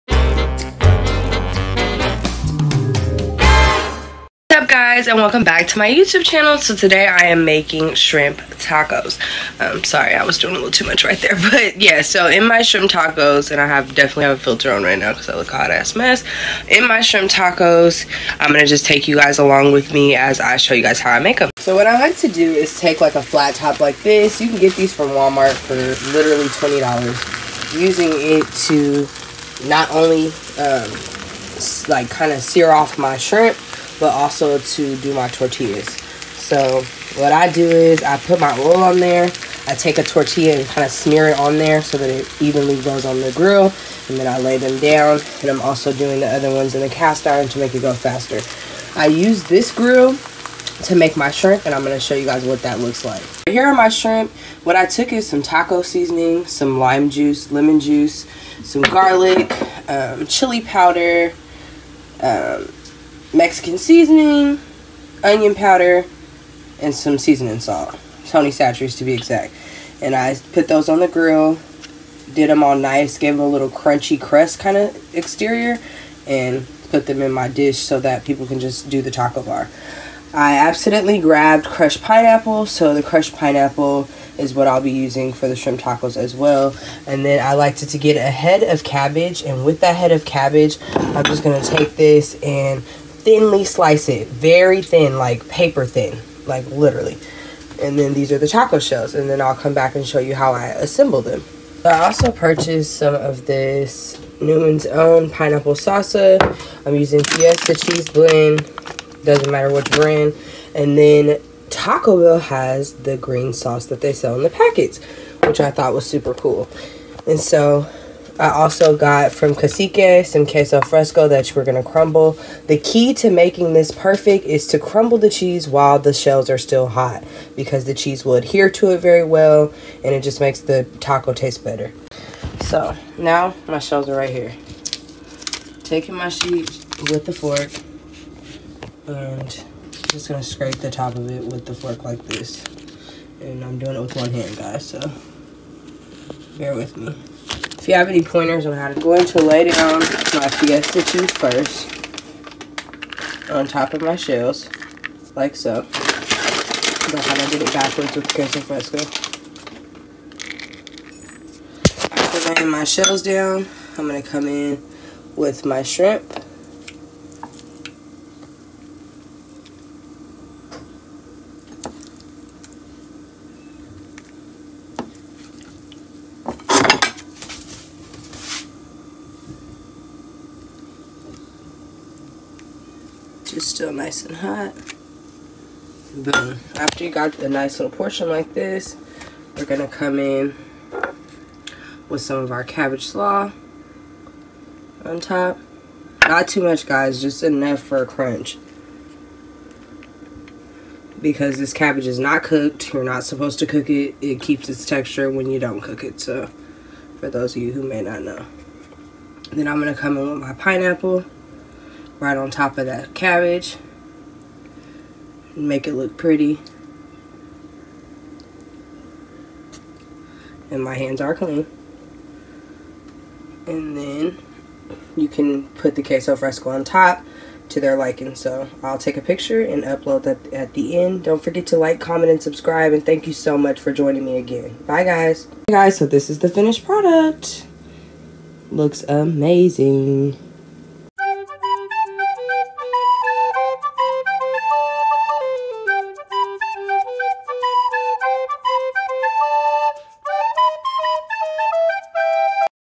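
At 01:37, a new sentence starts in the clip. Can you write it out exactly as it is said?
And then these are the taco shells, and then I'll come back and show you how I assemble them.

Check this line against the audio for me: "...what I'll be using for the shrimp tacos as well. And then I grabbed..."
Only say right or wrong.
wrong.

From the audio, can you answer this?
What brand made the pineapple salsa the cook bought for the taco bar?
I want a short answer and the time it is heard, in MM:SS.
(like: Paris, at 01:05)
Newman's Own, at 01:44.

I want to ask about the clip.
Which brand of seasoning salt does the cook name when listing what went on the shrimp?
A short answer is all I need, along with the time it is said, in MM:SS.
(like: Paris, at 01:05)
Tony Chachere's, at 01:08.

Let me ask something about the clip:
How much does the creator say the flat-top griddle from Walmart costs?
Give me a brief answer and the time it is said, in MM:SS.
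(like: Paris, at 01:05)
$20, at 00:26.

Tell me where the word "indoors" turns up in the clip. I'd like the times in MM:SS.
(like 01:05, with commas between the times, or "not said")
not said.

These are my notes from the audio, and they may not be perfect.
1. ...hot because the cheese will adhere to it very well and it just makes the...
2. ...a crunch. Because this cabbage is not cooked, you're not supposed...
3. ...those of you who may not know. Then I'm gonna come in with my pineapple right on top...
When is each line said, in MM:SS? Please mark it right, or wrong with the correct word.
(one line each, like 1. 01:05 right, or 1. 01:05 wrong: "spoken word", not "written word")
1. 02:06 right
2. 03:18 right
3. 03:27 right.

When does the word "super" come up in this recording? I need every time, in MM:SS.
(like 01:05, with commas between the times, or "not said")
01:56.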